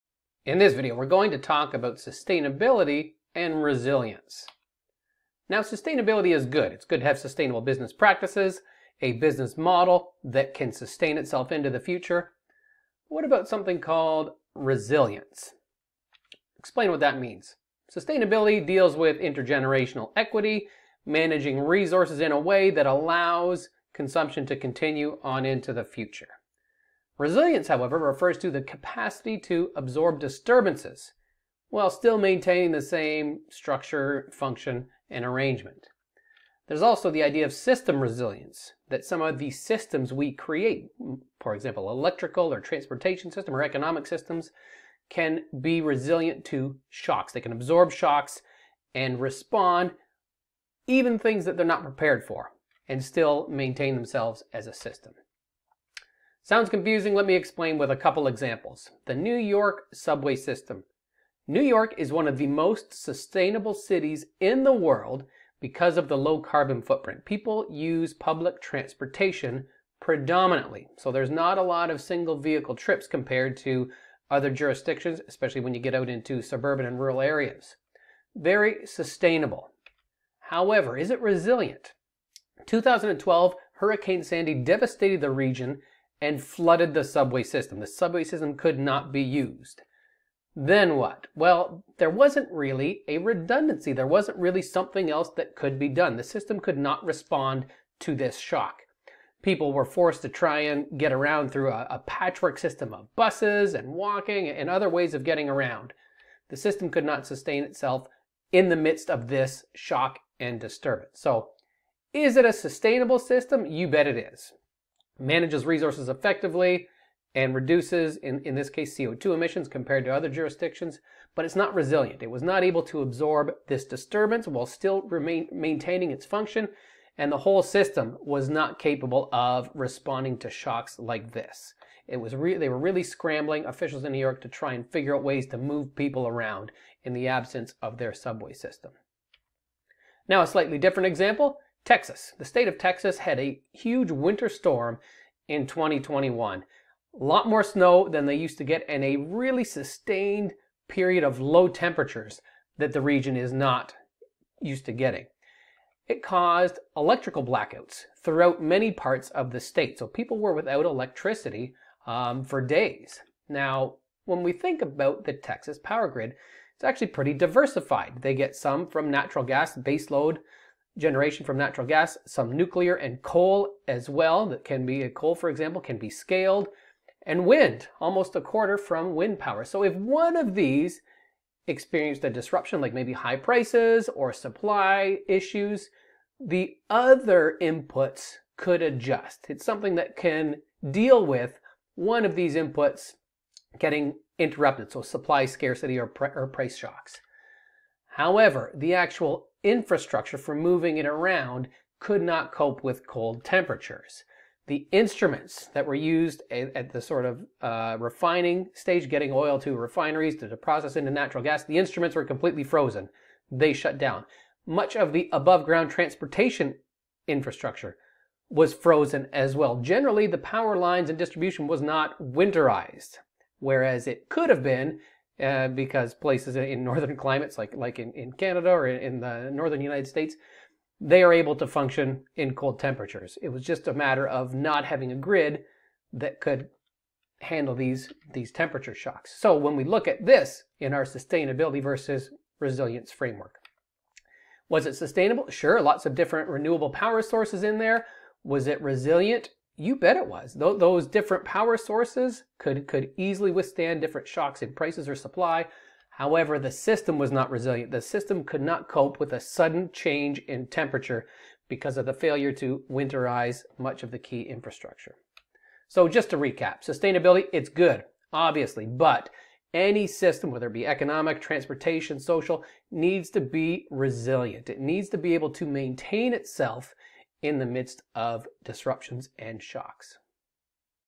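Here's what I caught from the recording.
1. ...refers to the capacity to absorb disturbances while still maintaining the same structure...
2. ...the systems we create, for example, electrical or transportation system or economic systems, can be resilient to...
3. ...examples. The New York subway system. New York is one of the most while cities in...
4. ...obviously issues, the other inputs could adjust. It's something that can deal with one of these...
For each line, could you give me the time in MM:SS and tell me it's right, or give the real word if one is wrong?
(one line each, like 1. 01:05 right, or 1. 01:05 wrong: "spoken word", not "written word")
1. 00:27 right
2. 00:39 right
3. 00:58 wrong: "sustainable", not "while"
4. 03:04 wrong: "supply", not "obviously".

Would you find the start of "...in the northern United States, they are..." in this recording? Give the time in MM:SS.
03:48.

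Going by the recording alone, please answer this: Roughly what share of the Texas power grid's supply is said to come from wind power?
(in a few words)
almost a quarter.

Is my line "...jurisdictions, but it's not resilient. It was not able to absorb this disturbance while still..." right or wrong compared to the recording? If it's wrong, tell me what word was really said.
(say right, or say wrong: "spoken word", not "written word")
right.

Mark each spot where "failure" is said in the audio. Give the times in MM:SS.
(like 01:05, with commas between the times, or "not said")
04:22.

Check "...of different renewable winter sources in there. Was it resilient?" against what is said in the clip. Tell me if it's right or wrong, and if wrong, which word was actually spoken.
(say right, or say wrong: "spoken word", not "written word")
wrong: "power", not "winter".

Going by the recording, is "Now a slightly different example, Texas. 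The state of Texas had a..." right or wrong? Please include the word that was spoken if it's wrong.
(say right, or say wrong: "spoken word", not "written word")
right.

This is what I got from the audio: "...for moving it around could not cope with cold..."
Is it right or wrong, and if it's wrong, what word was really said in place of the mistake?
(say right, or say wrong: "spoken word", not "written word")
right.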